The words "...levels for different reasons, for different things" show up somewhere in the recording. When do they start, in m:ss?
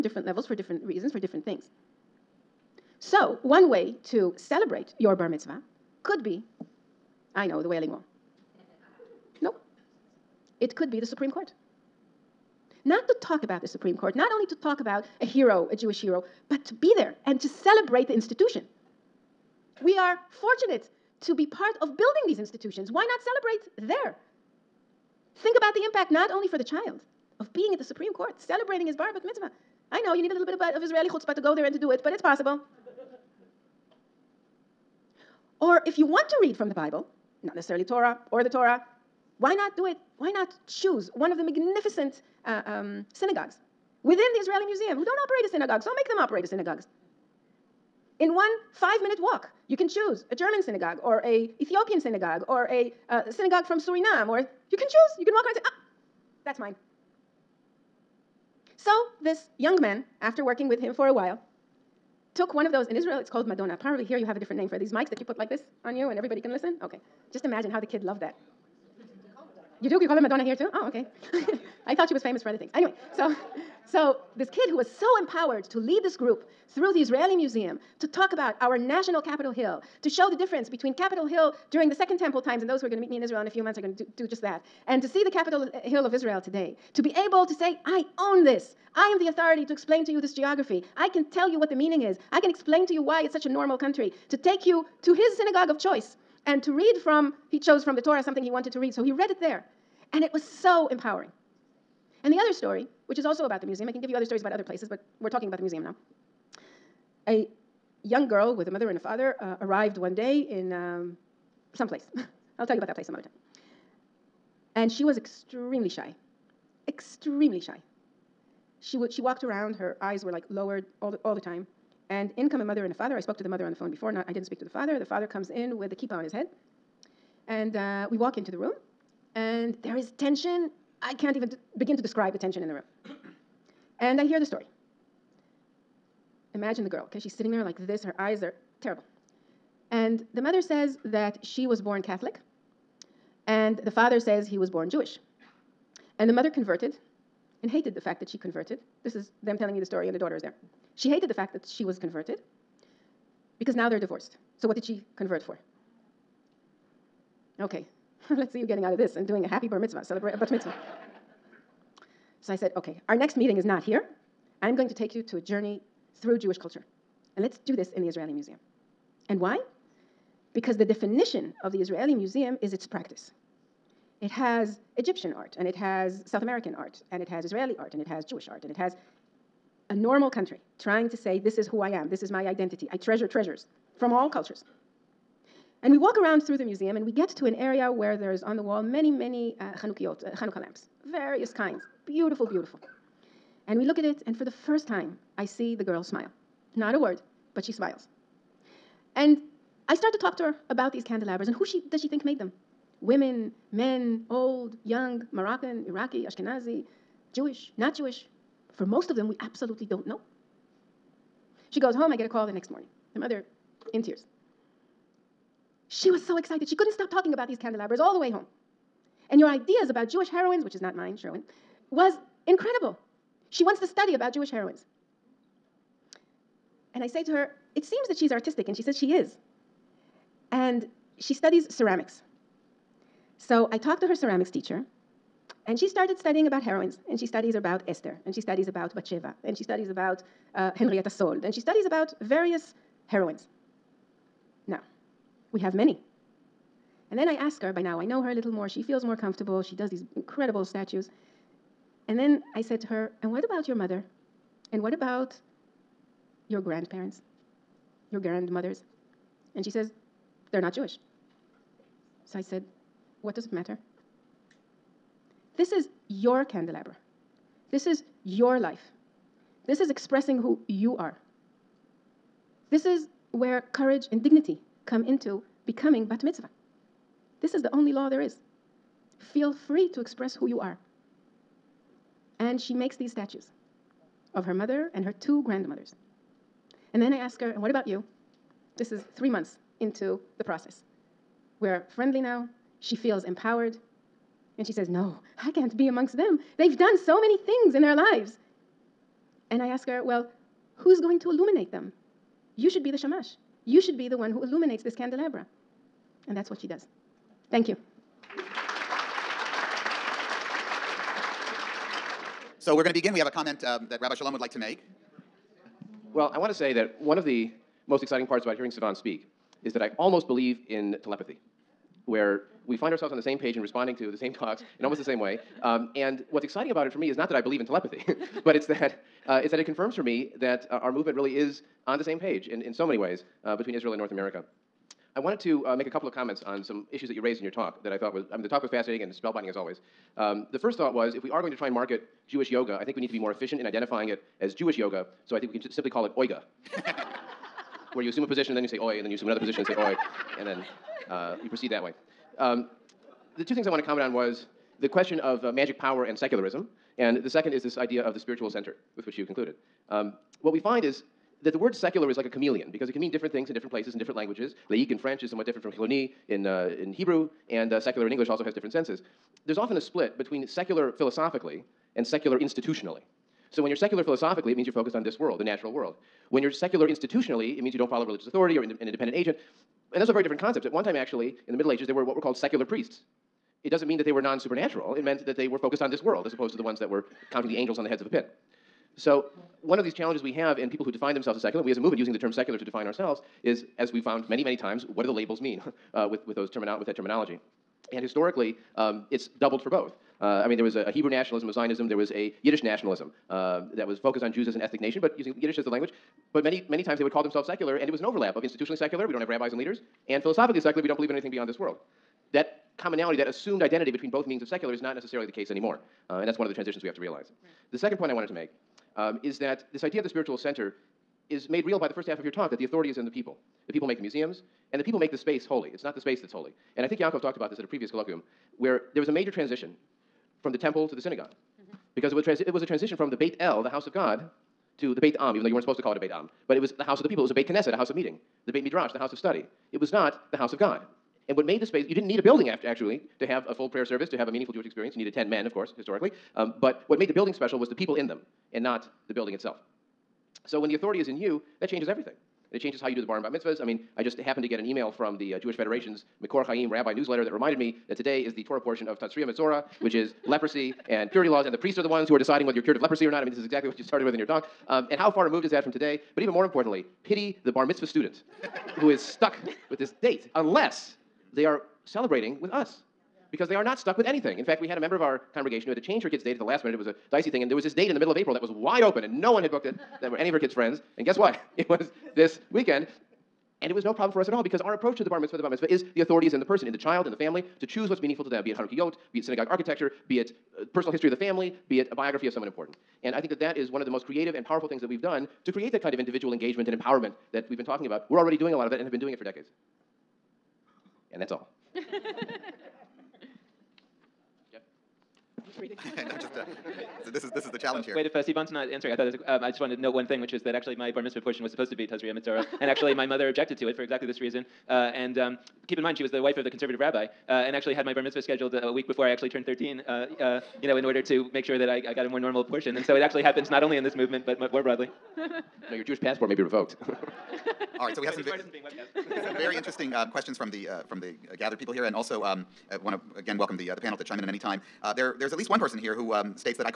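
0:00.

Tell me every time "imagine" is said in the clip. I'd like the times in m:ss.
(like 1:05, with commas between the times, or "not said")
1:07, 2:16.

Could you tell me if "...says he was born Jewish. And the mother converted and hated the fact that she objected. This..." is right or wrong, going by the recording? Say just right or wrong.
wrong.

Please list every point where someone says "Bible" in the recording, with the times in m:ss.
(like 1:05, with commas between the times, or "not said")
0:36.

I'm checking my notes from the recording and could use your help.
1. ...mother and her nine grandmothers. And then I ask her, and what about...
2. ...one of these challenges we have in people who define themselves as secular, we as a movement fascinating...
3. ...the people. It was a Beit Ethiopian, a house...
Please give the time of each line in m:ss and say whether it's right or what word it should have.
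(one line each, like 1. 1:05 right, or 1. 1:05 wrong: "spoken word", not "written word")
1. 4:44 wrong: "two", not "nine"
2. 6:29 wrong: "using", not "fascinating"
3. 7:17 wrong: "Knesset", not "Ethiopian".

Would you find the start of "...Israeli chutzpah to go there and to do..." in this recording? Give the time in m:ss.
0:30.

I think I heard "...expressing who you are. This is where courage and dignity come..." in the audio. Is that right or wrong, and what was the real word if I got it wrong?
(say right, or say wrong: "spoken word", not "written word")
right.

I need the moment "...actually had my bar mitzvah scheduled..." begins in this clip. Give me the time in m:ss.
8:37.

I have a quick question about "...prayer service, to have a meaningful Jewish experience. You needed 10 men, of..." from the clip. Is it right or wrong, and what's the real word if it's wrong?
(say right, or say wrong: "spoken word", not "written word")
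right.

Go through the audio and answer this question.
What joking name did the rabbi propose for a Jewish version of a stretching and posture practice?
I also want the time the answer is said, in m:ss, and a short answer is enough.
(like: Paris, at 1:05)
Oiga, at 5:46.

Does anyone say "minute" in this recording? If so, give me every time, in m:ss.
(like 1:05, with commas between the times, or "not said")
0:49, 7:56.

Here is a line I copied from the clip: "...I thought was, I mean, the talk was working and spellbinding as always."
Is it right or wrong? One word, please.
wrong.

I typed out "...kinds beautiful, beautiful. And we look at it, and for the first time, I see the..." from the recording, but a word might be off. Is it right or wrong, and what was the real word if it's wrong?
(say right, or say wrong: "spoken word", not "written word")
right.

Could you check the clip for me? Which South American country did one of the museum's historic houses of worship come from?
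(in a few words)
Suriname.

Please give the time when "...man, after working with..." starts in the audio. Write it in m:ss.
0:59.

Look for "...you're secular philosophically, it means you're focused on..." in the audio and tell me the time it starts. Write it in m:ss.
6:13.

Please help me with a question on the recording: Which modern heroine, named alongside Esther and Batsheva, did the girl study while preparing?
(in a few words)
Henrietta Szold.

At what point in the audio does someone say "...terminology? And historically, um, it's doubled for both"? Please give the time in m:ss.
6:36.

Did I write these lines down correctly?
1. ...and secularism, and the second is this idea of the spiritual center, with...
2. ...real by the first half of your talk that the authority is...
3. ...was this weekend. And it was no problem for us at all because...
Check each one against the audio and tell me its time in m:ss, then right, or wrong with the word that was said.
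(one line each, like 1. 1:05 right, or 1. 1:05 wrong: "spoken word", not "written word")
1. 5:56 right
2. 7:01 right
3. 8:01 right.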